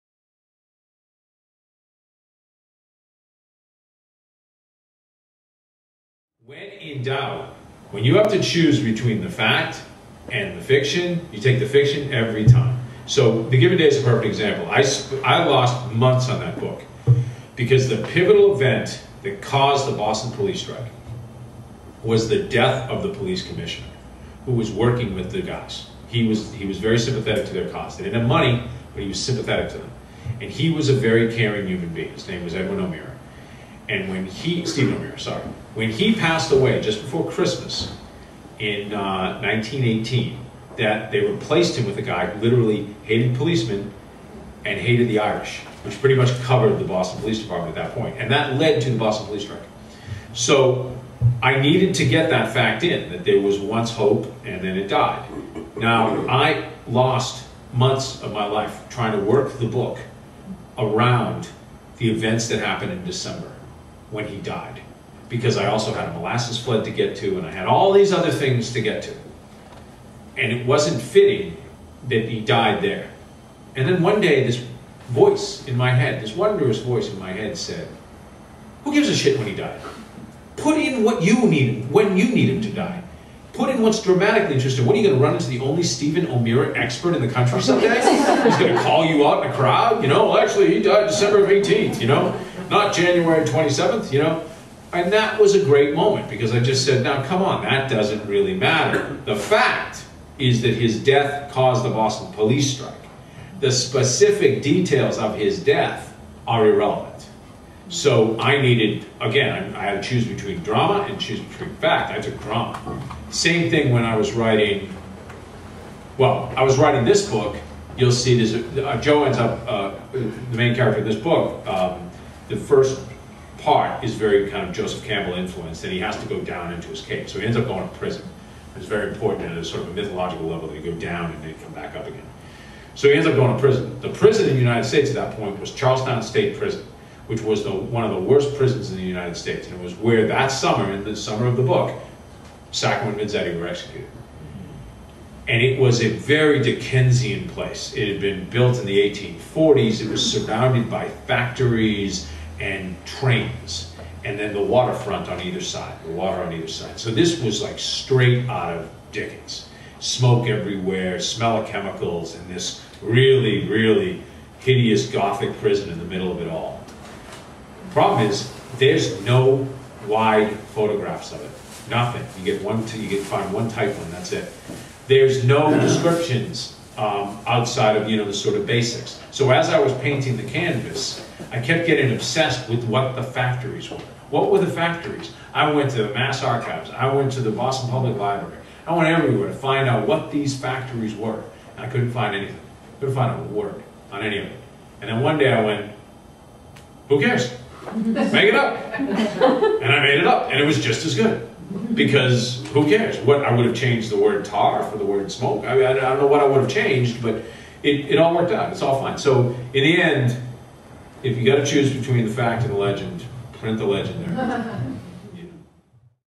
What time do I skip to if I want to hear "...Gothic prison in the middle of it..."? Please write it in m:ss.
2:45.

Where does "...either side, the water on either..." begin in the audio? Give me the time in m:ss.
2:35.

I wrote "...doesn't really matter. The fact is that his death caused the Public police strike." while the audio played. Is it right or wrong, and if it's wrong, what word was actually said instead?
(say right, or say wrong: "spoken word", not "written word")
wrong: "Boston", not "Public".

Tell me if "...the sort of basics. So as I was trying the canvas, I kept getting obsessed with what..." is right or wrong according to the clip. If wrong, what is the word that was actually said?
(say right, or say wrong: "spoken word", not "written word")
wrong: "painting", not "trying".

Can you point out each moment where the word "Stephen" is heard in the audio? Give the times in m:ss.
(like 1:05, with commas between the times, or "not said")
0:34, 1:25.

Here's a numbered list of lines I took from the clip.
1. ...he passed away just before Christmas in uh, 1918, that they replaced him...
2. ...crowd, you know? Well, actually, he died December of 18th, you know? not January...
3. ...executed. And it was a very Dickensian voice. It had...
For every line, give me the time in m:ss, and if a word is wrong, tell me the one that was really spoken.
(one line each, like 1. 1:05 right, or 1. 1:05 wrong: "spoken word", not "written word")
1. 0:35 right
2. 1:29 right
3. 2:23 wrong: "place", not "voice".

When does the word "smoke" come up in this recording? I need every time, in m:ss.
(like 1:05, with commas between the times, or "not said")
2:39, 3:25.